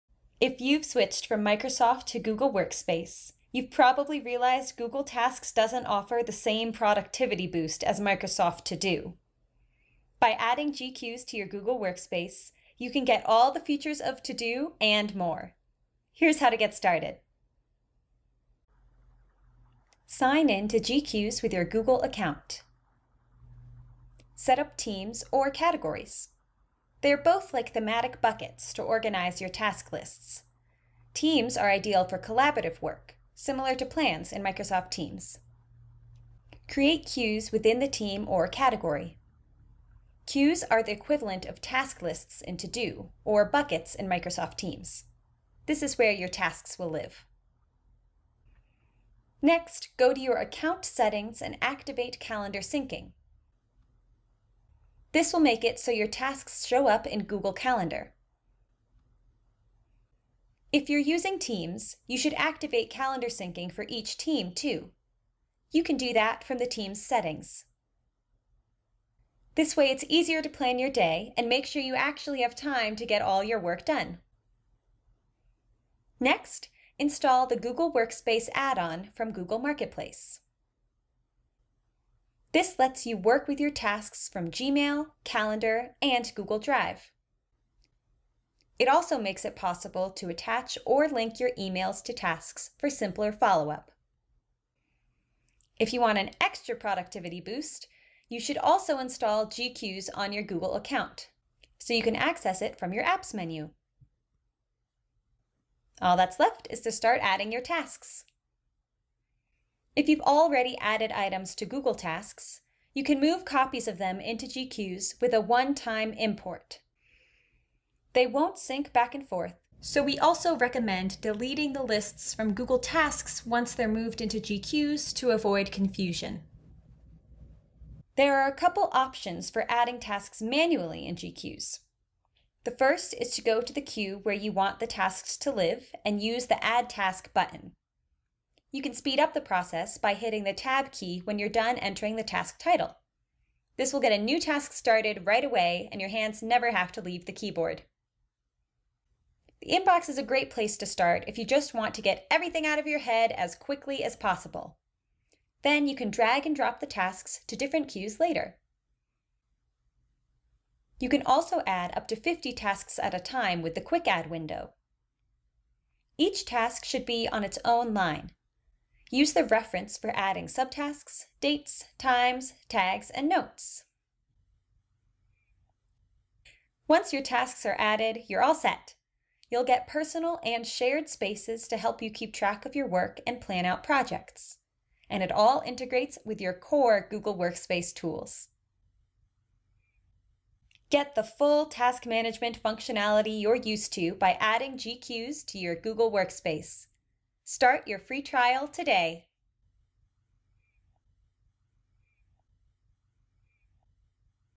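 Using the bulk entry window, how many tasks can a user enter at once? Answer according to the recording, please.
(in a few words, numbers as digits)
50.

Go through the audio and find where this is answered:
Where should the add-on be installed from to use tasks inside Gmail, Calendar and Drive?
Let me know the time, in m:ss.
1:19.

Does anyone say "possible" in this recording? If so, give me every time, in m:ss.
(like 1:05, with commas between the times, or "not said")
1:29, 2:34.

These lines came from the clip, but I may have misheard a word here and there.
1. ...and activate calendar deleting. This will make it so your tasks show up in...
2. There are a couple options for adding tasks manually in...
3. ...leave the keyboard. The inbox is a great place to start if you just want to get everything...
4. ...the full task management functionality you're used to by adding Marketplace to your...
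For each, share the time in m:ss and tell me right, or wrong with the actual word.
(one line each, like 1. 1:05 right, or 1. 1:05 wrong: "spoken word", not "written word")
1. 0:51 wrong: "syncing", not "deleting"
2. 2:08 right
3. 2:27 right
4. 3:11 wrong: "GQueues", not "Marketplace".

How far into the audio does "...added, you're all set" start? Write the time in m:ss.
2:57.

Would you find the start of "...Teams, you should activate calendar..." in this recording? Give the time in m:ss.
1:01.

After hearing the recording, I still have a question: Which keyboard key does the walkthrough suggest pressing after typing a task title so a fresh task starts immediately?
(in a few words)
Tab.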